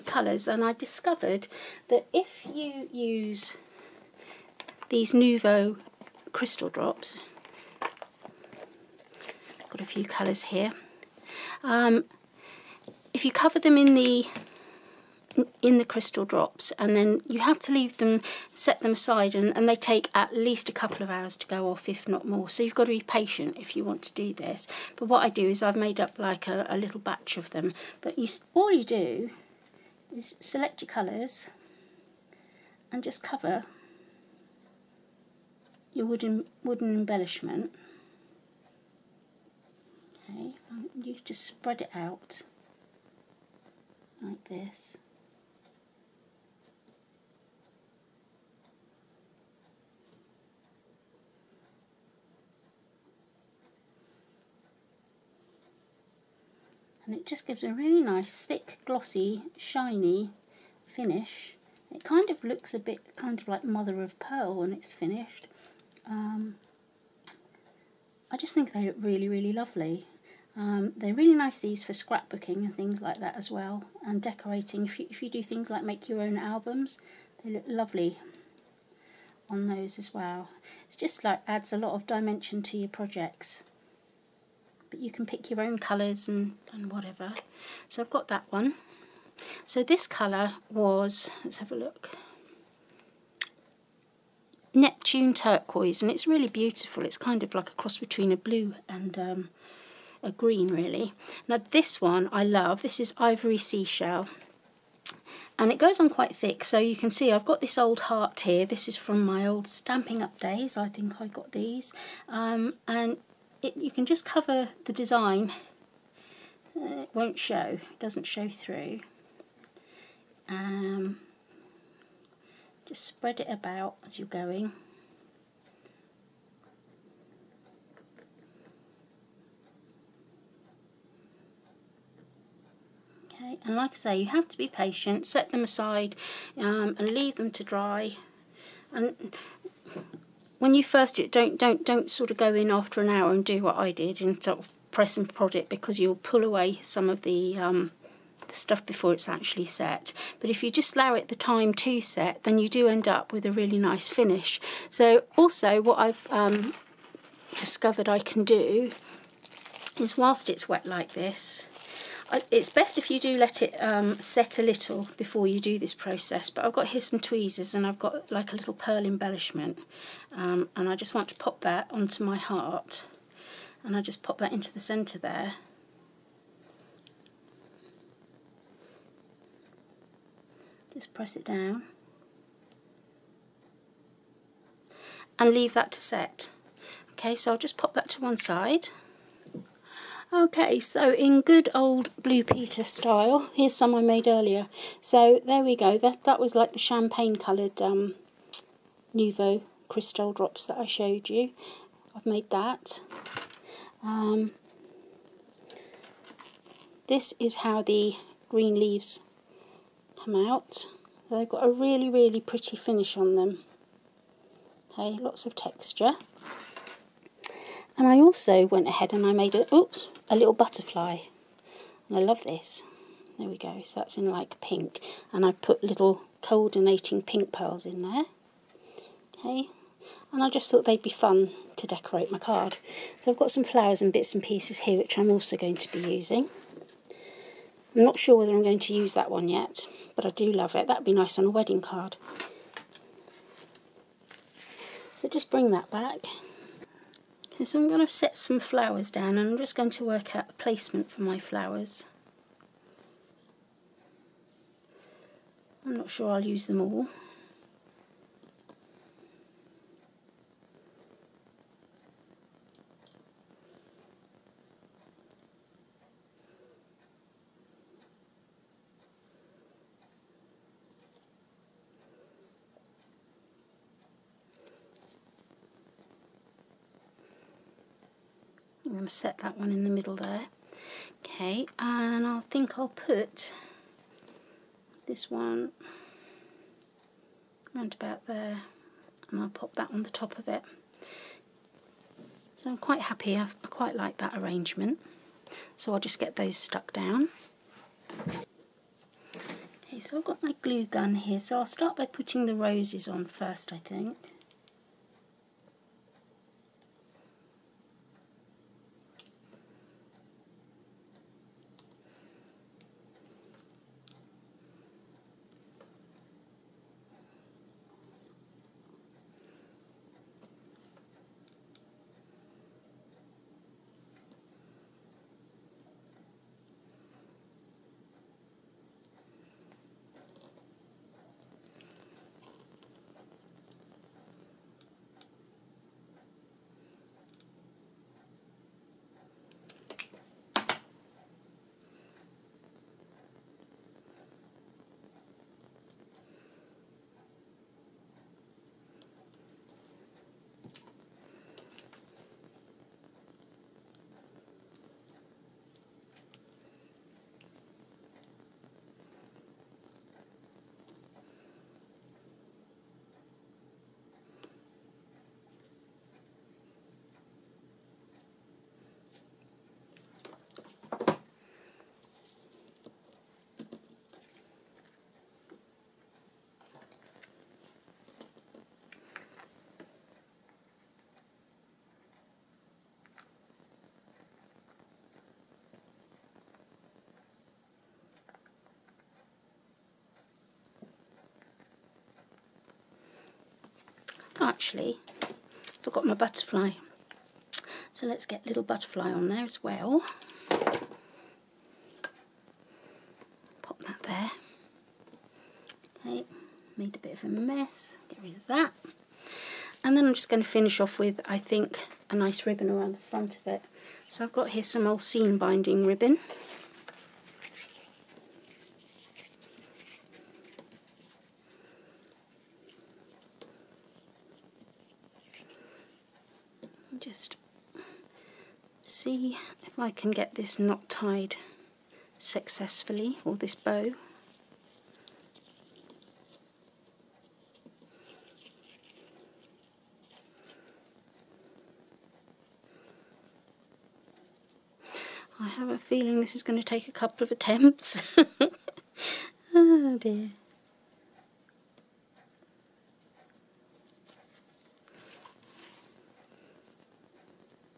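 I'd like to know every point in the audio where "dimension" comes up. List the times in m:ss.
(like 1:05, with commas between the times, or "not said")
1:22.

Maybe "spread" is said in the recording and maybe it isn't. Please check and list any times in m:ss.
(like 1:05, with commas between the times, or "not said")
0:41, 2:03.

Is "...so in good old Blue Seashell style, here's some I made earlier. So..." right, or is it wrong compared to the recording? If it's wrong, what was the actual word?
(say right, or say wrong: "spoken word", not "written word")
wrong: "Peter", not "Seashell".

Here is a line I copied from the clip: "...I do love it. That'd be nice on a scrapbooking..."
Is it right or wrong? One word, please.
wrong.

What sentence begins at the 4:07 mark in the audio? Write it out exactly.
So I'm going to set some flowers down and I'm just going to work out a placement for my flowers.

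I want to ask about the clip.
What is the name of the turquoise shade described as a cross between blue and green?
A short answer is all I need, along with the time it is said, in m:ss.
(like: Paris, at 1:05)
Neptune turquoise, at 1:34.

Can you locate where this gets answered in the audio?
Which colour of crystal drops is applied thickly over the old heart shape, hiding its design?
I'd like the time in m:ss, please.
1:43.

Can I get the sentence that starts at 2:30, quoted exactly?
But if you just allow it the time to set, then you do end up with a really nice finish.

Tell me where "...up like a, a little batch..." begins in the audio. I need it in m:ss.
0:26.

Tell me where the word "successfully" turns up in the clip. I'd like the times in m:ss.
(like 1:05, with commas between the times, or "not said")
7:12.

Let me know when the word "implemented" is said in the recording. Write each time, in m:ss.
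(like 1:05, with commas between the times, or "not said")
not said.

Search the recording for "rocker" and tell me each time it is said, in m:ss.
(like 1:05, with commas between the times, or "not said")
not said.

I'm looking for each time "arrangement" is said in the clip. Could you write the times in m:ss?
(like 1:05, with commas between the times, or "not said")
4:54.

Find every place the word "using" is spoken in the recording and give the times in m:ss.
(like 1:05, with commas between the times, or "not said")
3:55.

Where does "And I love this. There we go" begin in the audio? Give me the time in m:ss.
3:42.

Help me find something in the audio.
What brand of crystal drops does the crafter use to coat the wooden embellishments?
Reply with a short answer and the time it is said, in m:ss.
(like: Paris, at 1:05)
Nuvo, at 0:05.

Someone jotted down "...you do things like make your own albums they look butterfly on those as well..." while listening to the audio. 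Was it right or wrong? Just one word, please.
wrong.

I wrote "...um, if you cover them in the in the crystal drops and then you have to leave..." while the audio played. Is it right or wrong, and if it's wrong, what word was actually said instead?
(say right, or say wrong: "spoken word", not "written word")
right.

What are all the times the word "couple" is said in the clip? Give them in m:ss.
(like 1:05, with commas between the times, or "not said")
0:20, 7:26.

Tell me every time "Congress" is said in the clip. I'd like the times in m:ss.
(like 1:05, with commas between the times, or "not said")
not said.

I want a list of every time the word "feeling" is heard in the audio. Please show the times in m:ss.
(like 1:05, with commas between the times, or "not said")
7:25.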